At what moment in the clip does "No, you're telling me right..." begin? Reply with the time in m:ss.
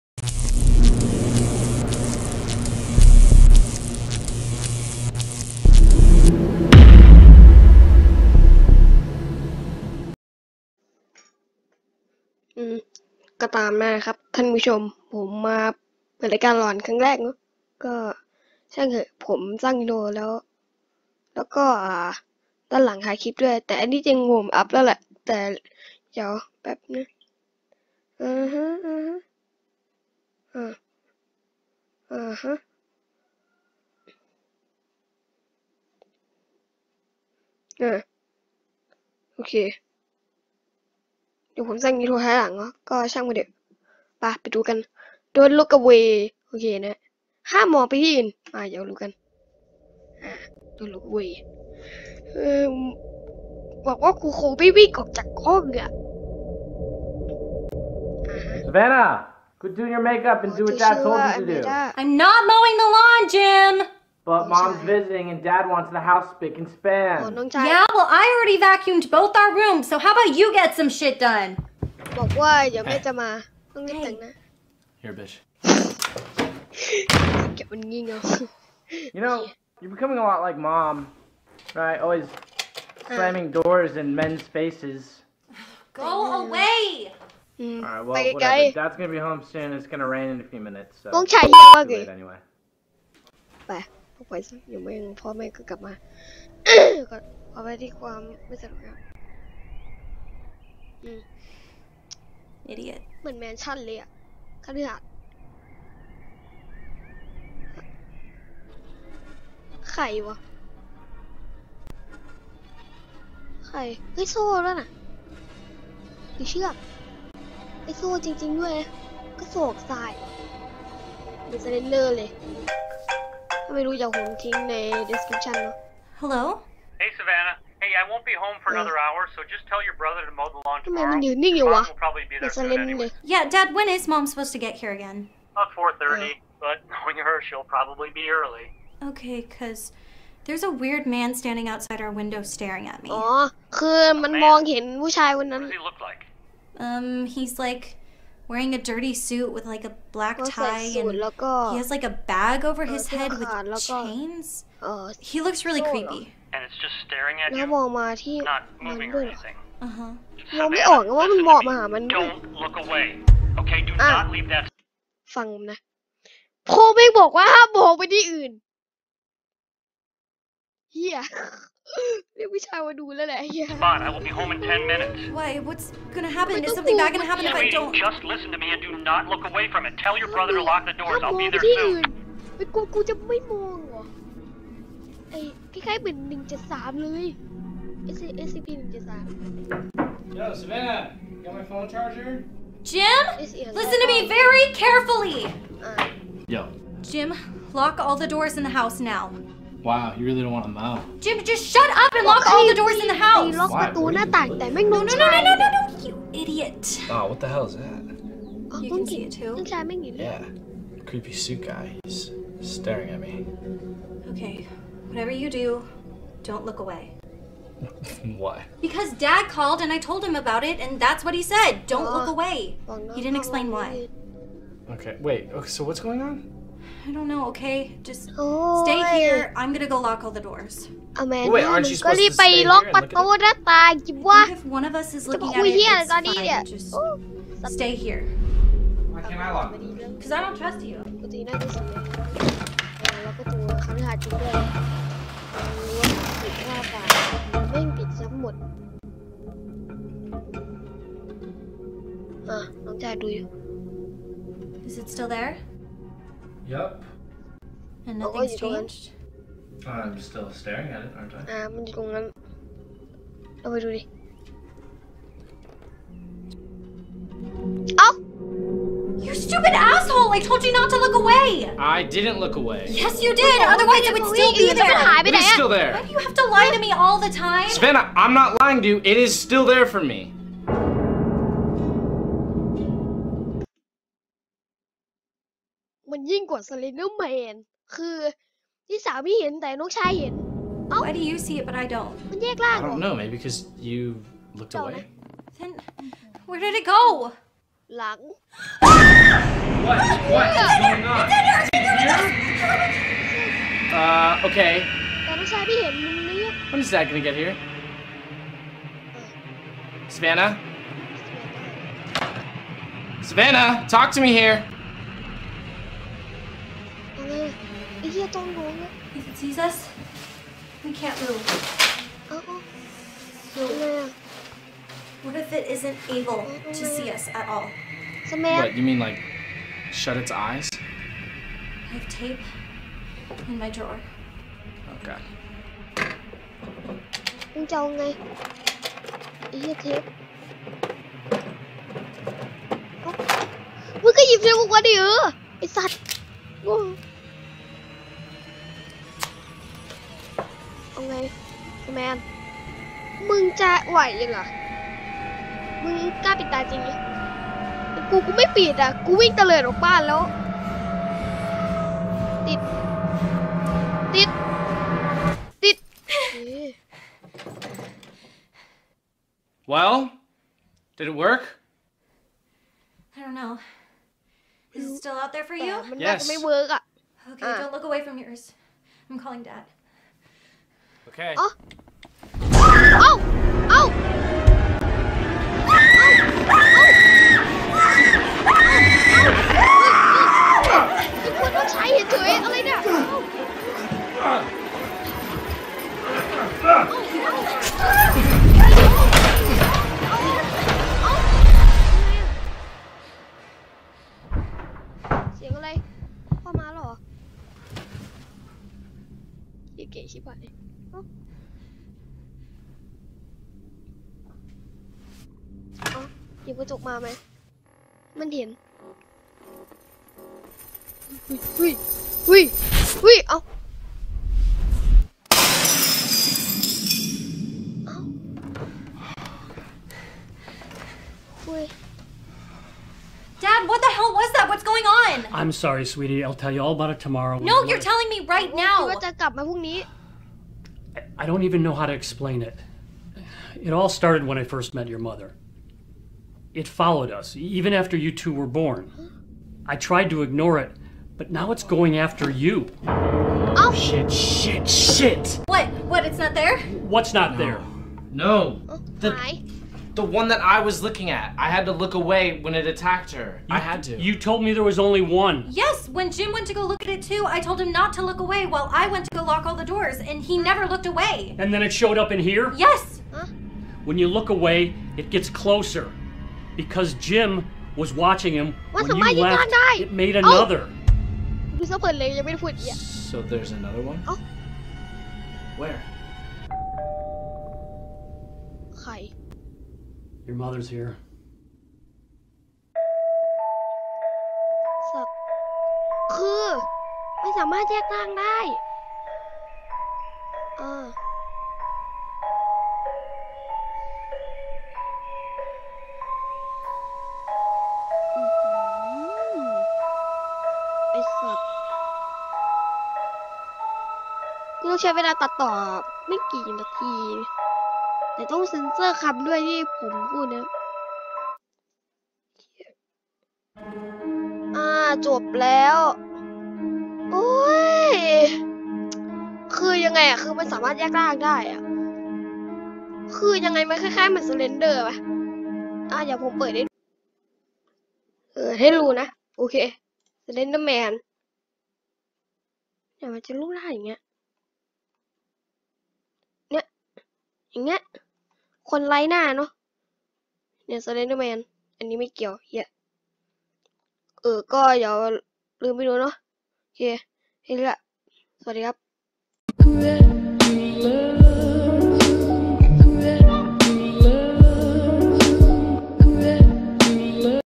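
7:17.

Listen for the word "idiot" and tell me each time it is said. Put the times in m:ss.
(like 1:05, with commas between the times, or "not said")
3:26, 5:18.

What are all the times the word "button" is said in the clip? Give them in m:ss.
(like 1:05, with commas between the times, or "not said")
not said.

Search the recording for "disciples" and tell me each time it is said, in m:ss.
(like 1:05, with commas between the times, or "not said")
not said.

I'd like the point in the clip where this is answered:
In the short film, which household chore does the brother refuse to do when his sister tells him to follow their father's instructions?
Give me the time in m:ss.
1:01.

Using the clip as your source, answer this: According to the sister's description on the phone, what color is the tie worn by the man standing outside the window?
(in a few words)
black.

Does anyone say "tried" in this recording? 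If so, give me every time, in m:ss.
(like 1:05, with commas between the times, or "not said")
7:29.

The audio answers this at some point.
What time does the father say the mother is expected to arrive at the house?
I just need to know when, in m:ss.
2:15.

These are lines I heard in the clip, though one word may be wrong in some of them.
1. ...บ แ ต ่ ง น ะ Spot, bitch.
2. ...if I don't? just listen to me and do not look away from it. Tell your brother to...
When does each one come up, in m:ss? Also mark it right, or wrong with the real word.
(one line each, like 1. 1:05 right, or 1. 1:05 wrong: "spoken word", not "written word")
1. 1:13 wrong: "Here", not "Spot"
2. 2:57 right.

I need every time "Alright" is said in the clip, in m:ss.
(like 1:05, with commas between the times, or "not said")
1:27.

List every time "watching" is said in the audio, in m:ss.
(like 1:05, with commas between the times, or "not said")
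7:57.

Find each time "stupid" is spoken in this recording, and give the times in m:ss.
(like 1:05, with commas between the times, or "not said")
4:29.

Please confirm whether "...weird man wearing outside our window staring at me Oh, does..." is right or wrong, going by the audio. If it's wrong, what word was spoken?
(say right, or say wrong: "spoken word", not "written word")
wrong: "standing", not "wearing".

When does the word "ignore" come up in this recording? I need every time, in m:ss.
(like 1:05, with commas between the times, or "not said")
7:30.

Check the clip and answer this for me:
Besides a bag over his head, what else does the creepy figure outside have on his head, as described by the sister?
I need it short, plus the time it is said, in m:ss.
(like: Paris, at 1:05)
chains, at 2:33.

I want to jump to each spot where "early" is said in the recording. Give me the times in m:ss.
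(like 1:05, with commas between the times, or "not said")
2:18.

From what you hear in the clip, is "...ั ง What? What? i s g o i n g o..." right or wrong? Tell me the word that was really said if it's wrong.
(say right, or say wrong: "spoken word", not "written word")
right.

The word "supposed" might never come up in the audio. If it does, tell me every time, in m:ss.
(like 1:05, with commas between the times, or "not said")
2:14, 3:51.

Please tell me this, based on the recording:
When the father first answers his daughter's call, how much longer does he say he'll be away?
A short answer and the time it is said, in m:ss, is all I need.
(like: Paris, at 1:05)
another hour, at 2:08.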